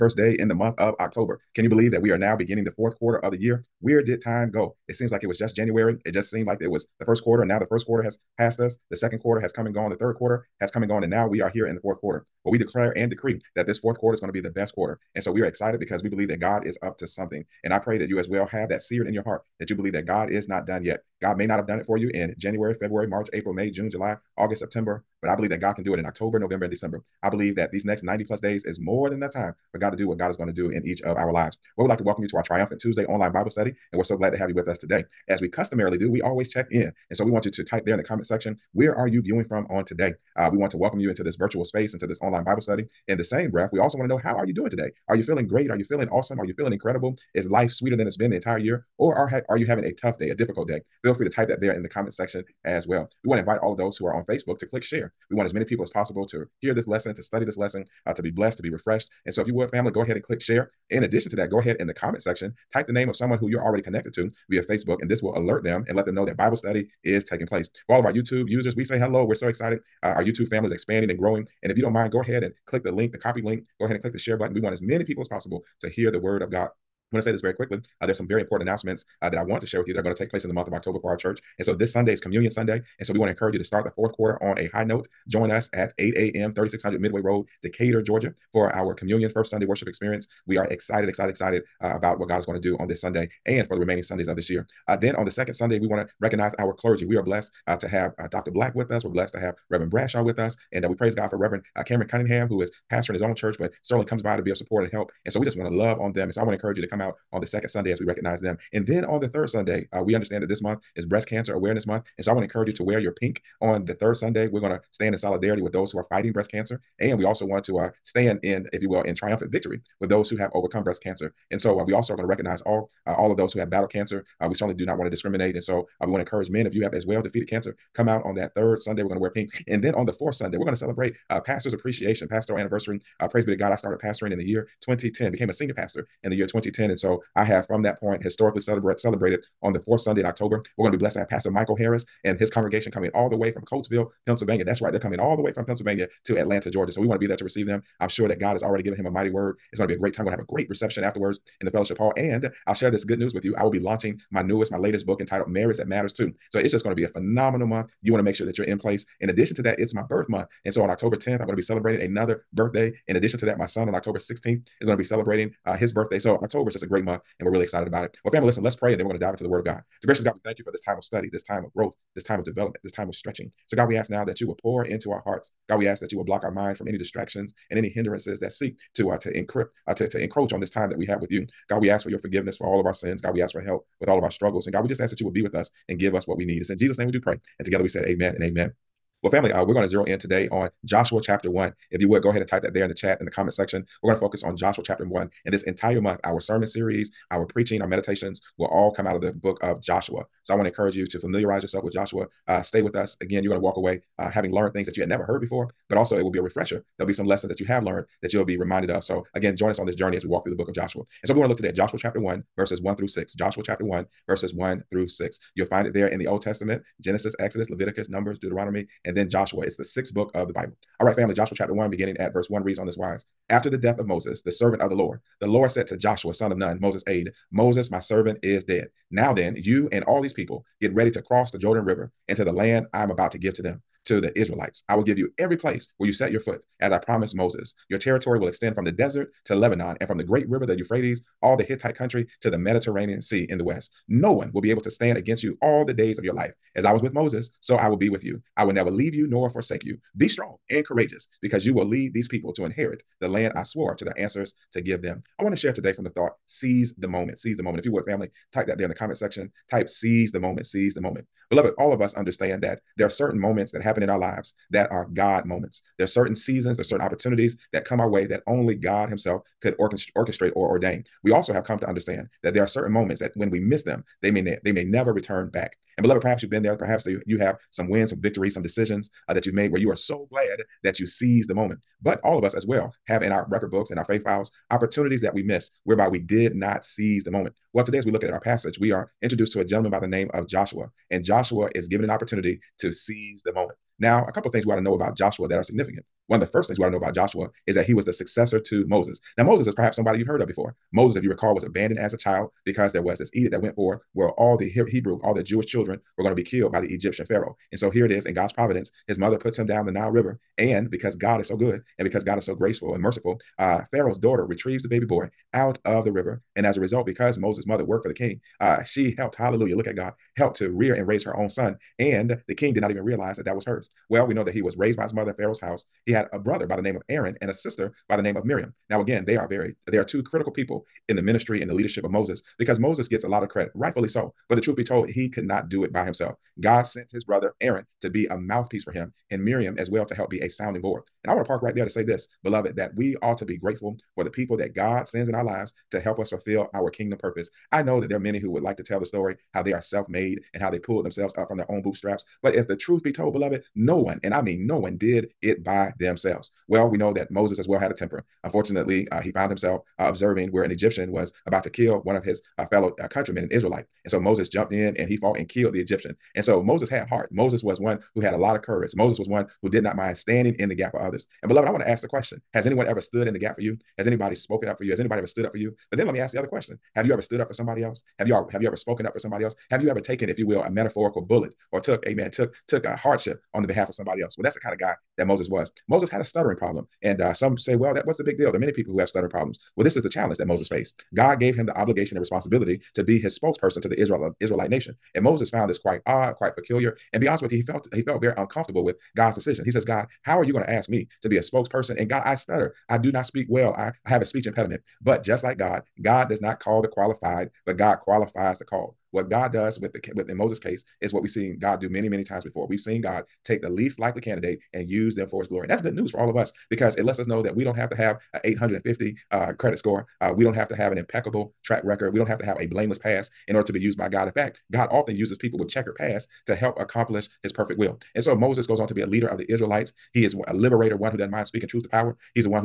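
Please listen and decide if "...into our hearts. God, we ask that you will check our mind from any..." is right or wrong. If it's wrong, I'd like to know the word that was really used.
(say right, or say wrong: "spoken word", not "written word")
wrong: "block", not "check".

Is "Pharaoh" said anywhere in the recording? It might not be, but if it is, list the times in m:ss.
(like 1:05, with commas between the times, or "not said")
5:07, 5:13, 5:25.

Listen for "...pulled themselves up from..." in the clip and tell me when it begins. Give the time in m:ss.
5:50.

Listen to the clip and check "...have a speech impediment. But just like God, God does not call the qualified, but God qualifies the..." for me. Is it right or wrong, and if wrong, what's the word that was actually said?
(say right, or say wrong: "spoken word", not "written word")
right.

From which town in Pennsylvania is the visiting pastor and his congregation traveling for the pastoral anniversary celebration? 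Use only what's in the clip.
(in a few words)
Coatesville.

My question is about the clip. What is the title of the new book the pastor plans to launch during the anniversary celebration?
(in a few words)
Marriage That Matters Too.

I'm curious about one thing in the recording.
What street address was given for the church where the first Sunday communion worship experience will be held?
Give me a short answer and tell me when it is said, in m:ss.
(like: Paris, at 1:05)
3600 Midway Road, at 1:26.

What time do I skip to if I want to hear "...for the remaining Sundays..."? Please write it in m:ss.
1:33.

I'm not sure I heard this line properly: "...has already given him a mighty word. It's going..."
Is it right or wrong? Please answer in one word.
right.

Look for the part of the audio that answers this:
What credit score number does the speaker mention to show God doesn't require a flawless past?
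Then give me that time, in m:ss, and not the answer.
6:58.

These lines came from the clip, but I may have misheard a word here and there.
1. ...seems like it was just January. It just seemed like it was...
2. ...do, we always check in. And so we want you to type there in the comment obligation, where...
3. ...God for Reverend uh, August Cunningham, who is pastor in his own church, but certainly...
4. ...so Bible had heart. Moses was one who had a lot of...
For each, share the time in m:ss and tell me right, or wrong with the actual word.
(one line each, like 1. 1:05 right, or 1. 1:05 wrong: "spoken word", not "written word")
1. 0:04 right
2. 0:35 wrong: "section", not "obligation"
3. 1:41 wrong: "Cameron", not "August"
4. 6:06 wrong: "Moses", not "Bible".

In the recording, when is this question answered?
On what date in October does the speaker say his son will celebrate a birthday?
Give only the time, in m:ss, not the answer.
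2:43.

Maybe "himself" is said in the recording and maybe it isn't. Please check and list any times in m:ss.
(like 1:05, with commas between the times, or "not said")
4:29, 5:36, 5:59.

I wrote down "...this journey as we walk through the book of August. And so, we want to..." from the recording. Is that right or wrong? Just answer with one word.
wrong.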